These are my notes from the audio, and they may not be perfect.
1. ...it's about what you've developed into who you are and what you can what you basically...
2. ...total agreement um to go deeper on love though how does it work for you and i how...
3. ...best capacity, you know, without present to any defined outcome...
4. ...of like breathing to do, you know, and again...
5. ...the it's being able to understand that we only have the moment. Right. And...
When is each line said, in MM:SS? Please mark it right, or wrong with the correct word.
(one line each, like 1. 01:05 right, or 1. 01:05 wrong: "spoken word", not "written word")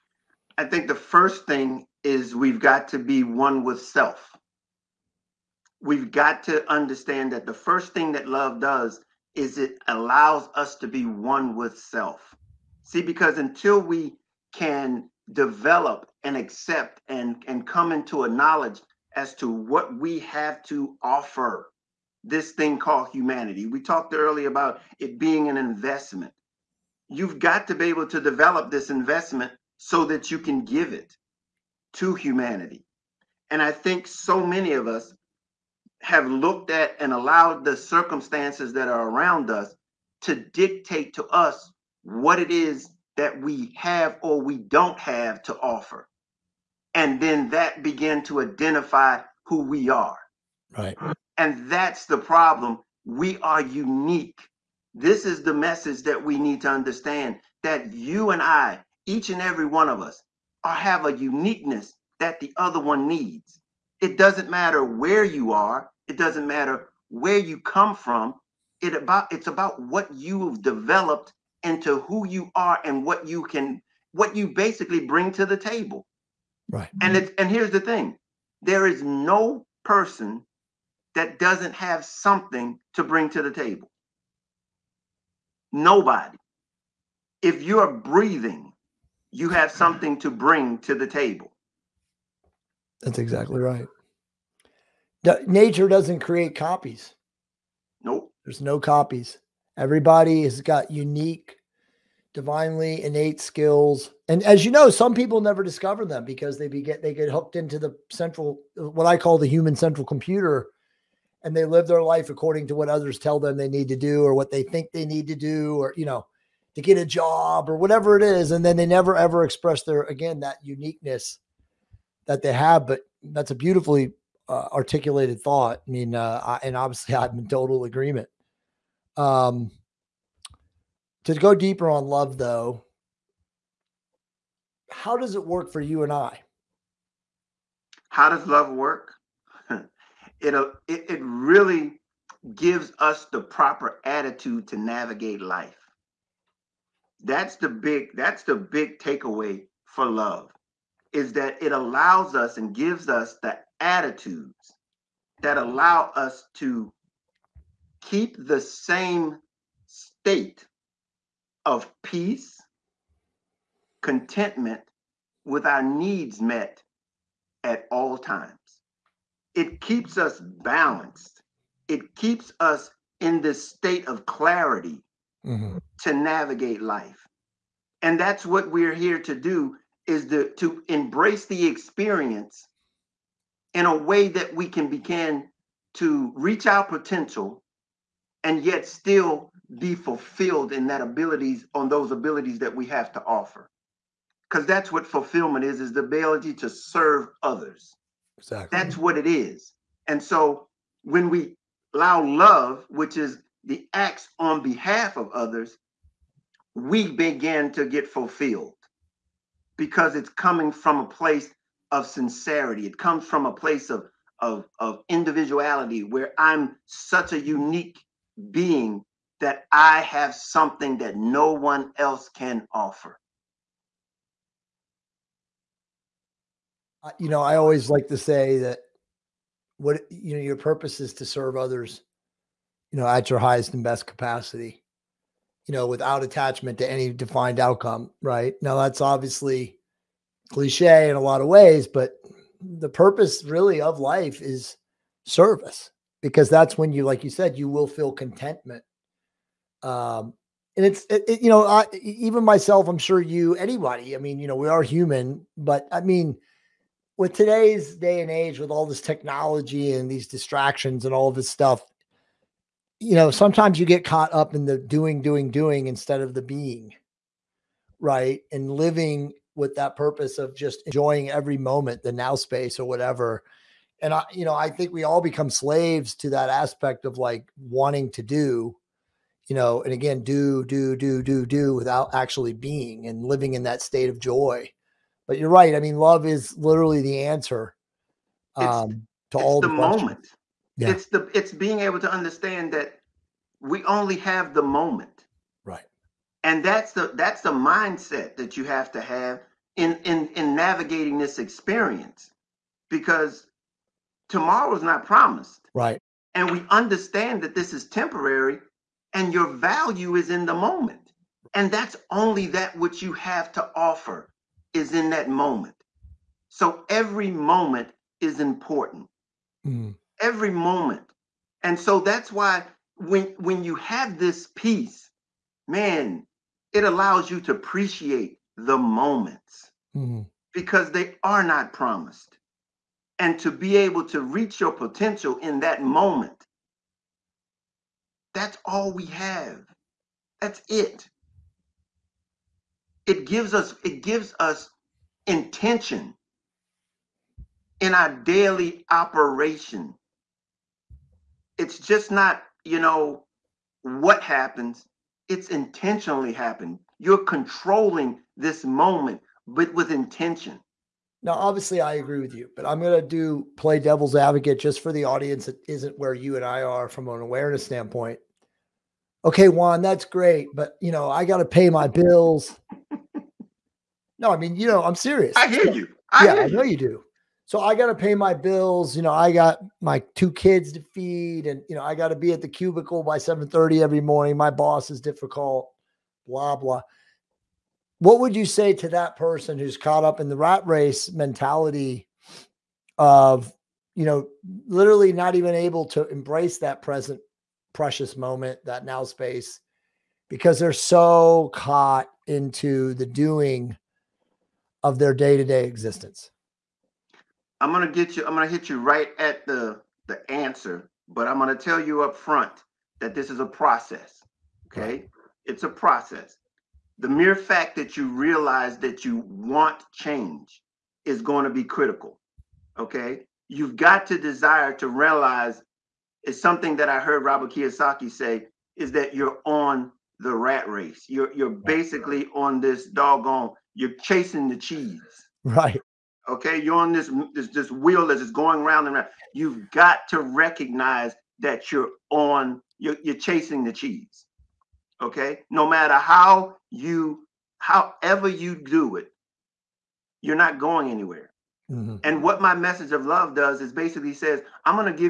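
1. 01:09 right
2. 02:07 right
3. 03:53 wrong: "attachment", not "present"
4. 04:37 wrong: "wanting", not "breathing"
5. 04:51 right.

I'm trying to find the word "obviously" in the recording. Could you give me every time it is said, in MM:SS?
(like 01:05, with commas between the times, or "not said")
02:06, 03:58, 06:01.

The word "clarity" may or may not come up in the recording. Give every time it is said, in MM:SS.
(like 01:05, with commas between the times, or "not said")
02:54.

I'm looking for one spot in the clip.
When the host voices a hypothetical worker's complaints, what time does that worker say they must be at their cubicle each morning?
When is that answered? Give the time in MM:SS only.
06:23.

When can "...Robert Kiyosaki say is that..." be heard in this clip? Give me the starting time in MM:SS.
07:07.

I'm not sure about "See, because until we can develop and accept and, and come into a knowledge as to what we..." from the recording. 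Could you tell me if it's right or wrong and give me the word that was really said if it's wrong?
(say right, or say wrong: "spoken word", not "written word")
right.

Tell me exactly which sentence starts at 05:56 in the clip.
You're controlling this moment, but with intention.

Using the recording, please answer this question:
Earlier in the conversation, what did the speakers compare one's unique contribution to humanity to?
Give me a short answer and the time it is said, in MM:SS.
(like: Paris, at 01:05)
an investment, at 00:25.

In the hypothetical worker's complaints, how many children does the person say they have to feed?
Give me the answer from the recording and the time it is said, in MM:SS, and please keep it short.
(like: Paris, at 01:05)
2, at 06:20.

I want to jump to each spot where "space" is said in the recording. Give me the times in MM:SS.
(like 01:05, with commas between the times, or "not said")
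04:32, 06:39.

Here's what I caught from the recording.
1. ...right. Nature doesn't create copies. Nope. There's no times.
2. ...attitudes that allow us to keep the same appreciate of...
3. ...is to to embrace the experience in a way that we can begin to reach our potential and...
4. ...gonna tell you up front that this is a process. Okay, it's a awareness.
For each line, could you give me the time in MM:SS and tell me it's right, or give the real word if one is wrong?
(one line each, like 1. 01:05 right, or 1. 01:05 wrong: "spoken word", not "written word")
1. 01:33 wrong: "copies", not "times"
2. 02:33 wrong: "state", not "appreciate"
3. 03:00 right
4. 06:51 wrong: "process", not "awareness".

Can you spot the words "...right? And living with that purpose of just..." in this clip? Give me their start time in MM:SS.
04:27.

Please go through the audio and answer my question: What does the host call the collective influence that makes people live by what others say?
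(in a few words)
human central computer.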